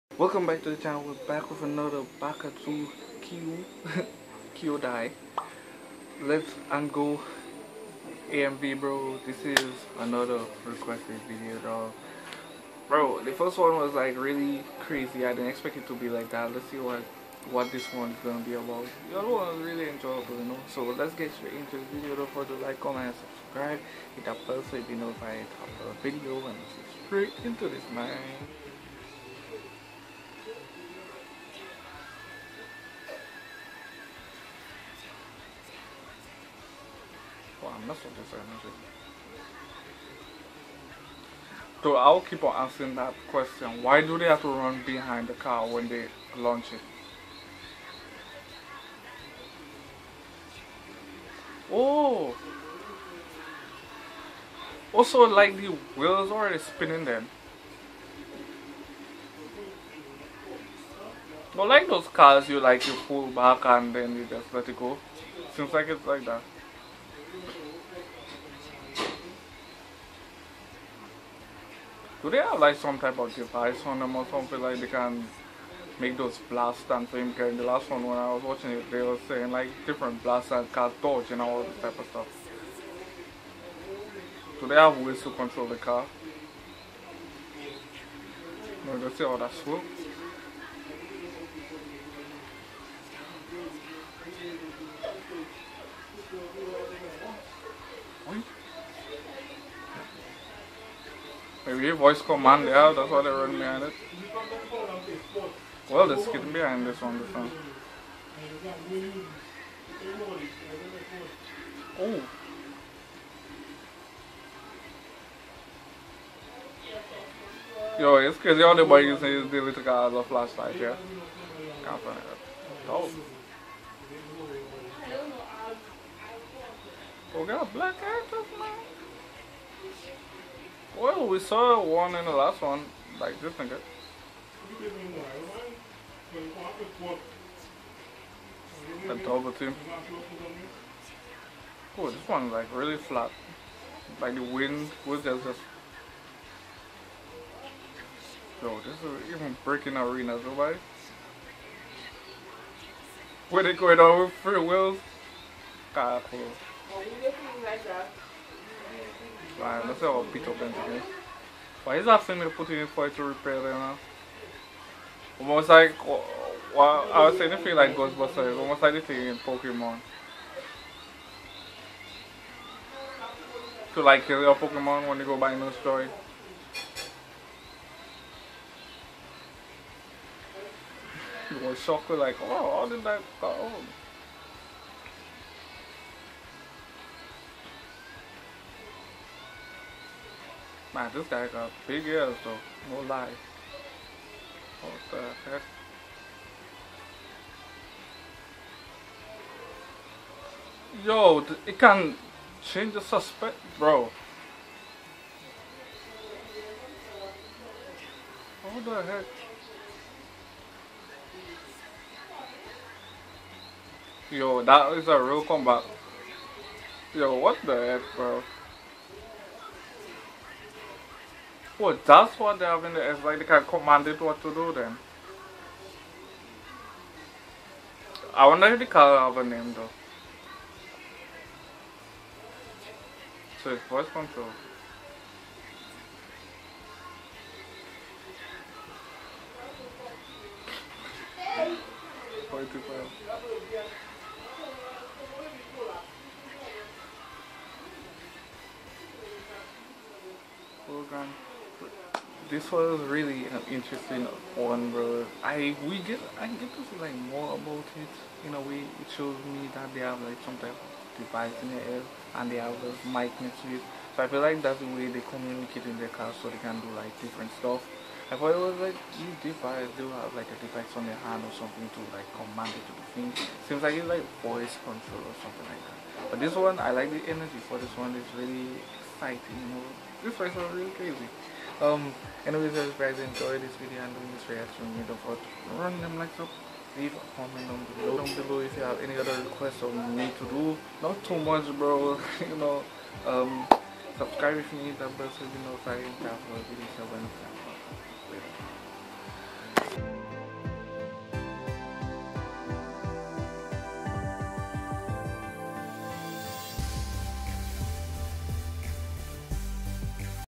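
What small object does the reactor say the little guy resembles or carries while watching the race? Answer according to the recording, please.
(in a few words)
A flashlight.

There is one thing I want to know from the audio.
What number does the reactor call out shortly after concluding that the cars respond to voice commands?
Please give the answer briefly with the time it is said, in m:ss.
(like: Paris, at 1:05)
45, at 4:02.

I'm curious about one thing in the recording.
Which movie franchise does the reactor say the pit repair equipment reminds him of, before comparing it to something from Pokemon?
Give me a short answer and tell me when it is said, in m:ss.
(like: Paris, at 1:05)
Ghostbusters, at 2:47.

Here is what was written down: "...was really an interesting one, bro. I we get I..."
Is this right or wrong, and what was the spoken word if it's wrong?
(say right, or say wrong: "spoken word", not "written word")
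right.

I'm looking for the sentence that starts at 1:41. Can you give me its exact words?
Maybe your voice command yeah, that's why they run behind it.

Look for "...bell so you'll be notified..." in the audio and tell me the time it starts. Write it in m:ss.
0:24.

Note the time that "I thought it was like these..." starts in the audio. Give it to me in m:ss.
4:28.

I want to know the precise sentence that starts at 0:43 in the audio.
Why do they have to run behind the car when they launch it?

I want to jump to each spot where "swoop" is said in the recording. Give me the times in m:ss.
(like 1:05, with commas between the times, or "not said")
1:29.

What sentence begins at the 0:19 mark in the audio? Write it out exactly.
The other one was really enjoyable, you know.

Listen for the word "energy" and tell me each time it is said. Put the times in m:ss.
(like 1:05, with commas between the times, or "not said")
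4:37.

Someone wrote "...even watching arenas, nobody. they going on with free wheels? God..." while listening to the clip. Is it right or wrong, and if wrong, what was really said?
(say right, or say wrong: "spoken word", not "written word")
wrong: "breaking", not "watching".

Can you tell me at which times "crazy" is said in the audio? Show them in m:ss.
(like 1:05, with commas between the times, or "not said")
0:14, 1:58, 4:40.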